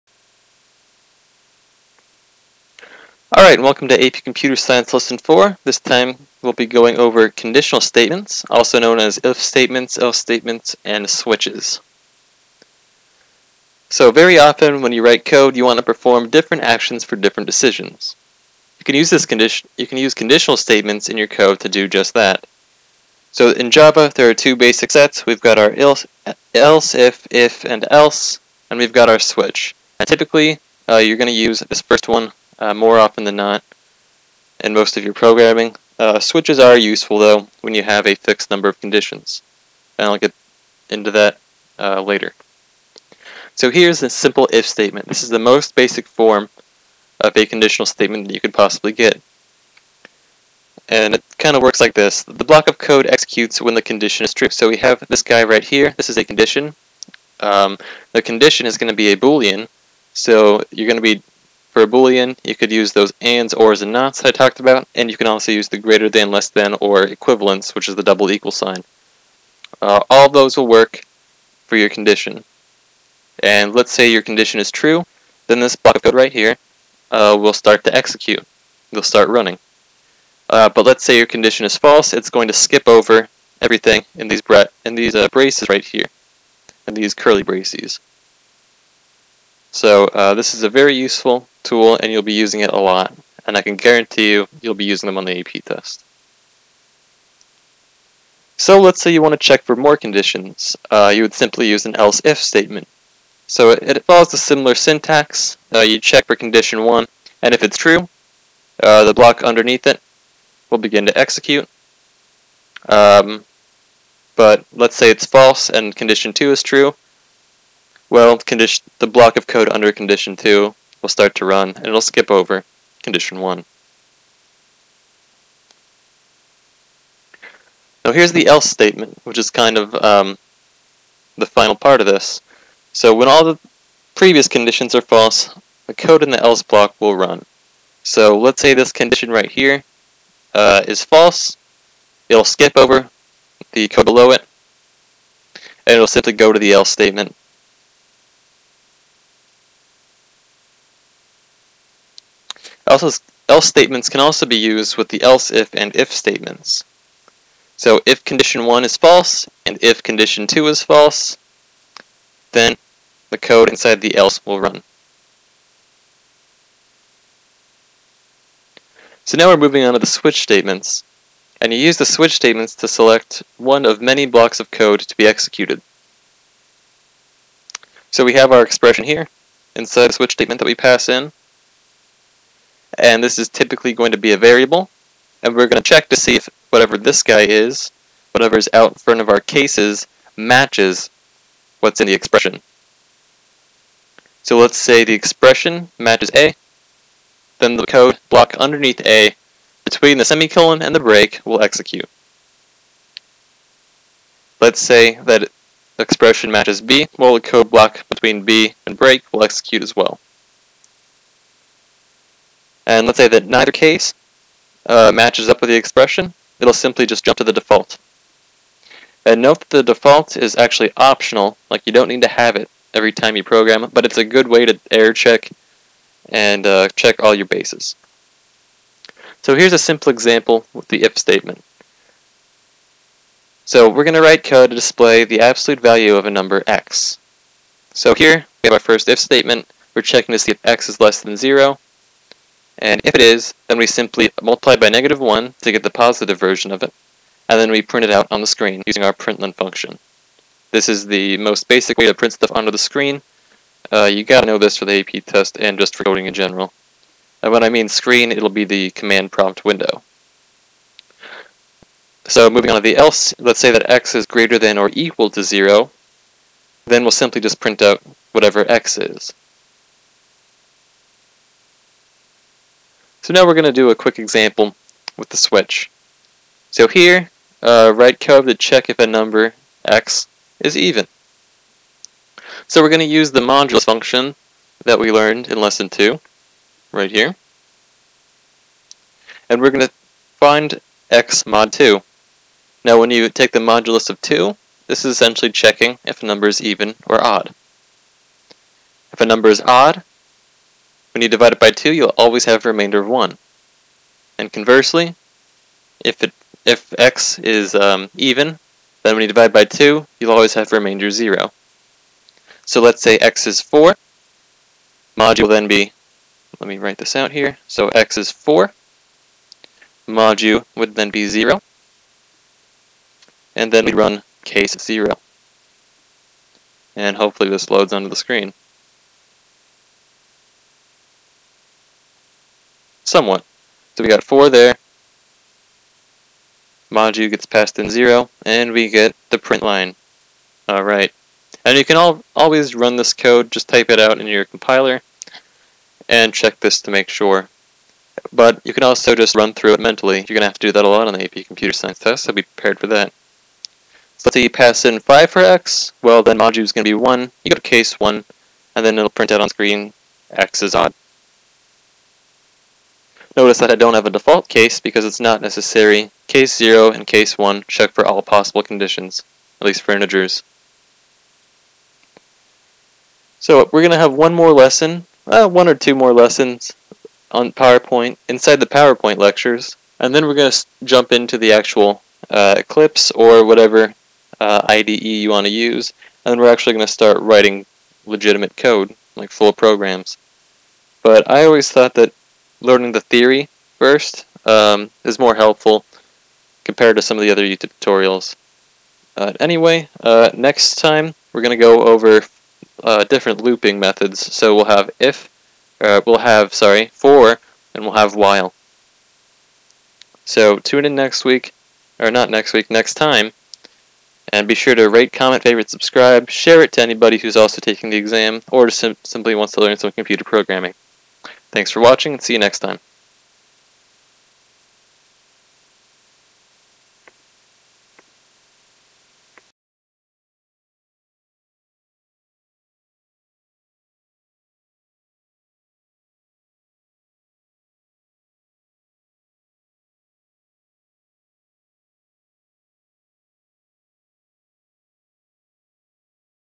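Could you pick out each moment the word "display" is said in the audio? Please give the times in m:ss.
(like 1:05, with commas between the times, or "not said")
3:54.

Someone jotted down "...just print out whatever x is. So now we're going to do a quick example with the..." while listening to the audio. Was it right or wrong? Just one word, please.
right.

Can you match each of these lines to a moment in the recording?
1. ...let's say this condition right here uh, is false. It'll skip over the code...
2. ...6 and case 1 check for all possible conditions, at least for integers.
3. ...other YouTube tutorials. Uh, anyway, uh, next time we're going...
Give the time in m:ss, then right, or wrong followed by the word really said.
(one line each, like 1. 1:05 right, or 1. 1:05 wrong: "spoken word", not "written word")
1. 2:18 right
2. 6:06 wrong: "0", not "6"
3. 6:37 right.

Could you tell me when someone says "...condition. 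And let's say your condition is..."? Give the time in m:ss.
1:11.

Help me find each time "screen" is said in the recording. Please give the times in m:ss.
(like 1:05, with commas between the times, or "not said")
4:08, 4:12, 4:17, 5:28, 5:59.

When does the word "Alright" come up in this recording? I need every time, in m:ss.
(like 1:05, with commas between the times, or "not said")
0:03, 5:40.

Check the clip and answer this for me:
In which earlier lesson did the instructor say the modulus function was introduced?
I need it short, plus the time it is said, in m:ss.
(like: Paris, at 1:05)
lesson 2, at 4:45.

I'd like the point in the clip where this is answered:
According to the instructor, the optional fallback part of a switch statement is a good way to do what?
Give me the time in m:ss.
3:44.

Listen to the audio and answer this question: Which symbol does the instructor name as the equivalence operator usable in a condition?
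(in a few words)
double equal sign.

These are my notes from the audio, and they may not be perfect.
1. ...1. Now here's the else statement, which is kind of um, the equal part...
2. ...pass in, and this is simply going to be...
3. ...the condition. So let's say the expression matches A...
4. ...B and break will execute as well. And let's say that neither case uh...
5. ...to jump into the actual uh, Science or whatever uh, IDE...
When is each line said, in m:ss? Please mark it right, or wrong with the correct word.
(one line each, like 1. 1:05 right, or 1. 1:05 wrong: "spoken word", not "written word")
1. 2:03 wrong: "final", not "equal"
2. 3:00 wrong: "typically", not "simply"
3. 3:12 wrong: "expression", not "condition"
4. 3:28 right
5. 6:20 wrong: "Eclipse", not "Science".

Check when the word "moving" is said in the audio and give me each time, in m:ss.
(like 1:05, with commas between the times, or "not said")
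2:49, 4:22.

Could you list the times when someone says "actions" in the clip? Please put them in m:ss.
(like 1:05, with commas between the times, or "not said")
0:16.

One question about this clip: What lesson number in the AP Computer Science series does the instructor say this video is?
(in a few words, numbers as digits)
4.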